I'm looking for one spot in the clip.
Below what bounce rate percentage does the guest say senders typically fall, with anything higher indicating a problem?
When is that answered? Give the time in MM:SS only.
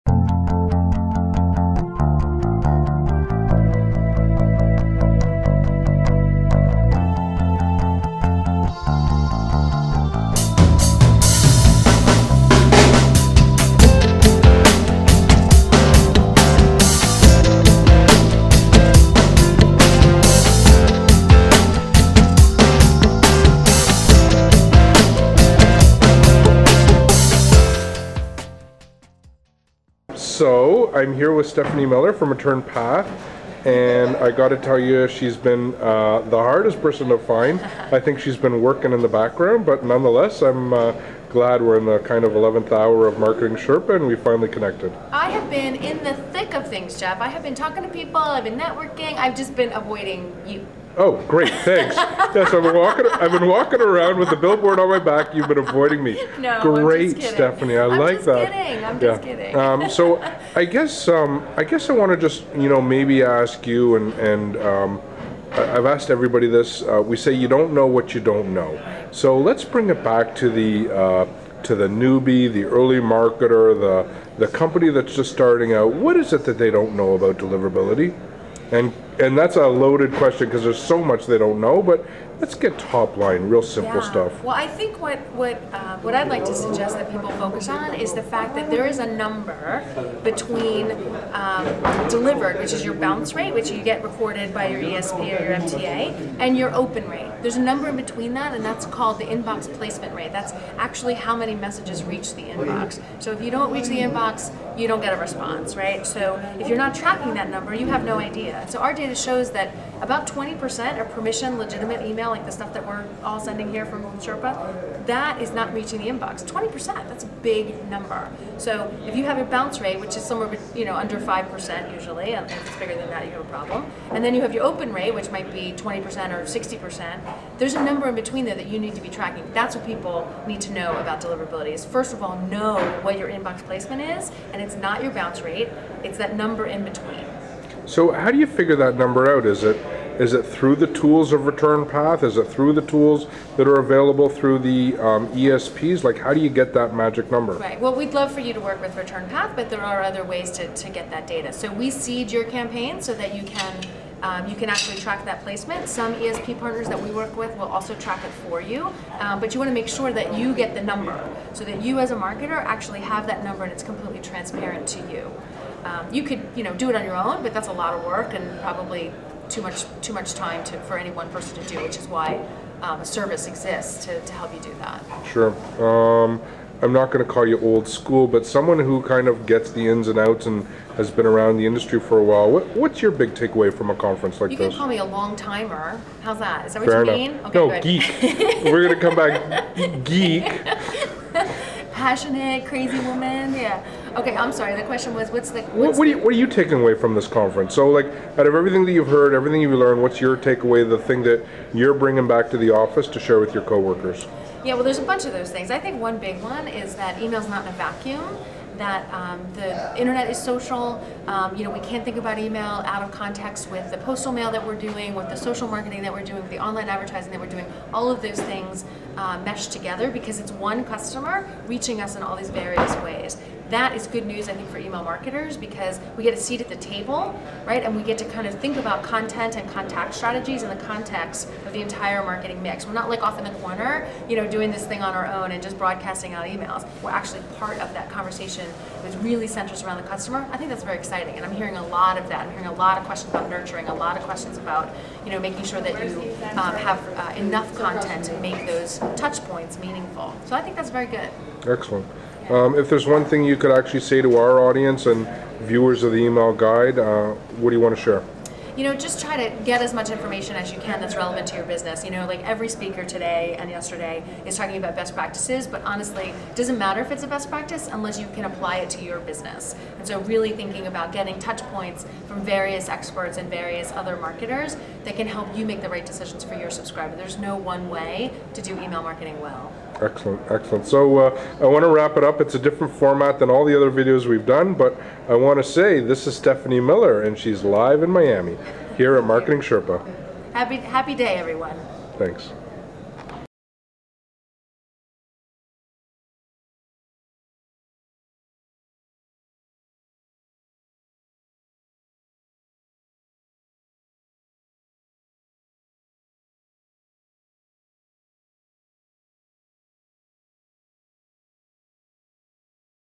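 02:01.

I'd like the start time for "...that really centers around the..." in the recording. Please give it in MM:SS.
03:59.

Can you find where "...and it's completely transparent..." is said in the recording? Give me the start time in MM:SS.
02:43.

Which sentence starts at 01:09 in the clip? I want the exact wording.
So let's bring it back to the.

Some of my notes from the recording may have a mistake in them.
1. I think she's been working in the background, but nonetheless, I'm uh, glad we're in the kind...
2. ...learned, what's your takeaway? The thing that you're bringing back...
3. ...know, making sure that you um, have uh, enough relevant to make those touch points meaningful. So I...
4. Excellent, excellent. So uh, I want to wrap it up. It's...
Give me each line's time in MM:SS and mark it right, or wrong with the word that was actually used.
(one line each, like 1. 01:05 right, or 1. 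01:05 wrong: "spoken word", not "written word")
1. 00:37 right
2. 03:19 right
3. 04:05 wrong: "content", not "relevant"
4. 04:40 right.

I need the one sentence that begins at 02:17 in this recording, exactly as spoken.
So how do you figure that number out?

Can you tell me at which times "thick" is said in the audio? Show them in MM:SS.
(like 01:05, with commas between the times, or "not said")
00:46.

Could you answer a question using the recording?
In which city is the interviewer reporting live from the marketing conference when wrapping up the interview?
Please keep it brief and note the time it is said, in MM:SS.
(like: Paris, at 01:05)
Miami, at 04:48.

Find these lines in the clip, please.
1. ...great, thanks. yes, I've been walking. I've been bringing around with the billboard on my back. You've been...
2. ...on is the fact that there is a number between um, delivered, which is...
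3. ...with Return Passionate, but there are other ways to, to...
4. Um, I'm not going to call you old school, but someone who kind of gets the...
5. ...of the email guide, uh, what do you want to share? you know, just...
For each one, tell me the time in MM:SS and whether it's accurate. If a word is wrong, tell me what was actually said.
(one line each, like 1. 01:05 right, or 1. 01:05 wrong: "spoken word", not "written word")
1. 00:51 wrong: "walking", not "bringing"
2. 01:27 right
3. 02:28 wrong: "Path", not "Passionate"
4. 02:55 right
5. 04:16 right.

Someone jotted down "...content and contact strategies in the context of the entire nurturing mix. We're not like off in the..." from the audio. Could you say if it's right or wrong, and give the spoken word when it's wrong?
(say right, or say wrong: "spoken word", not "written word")
wrong: "marketing", not "nurturing".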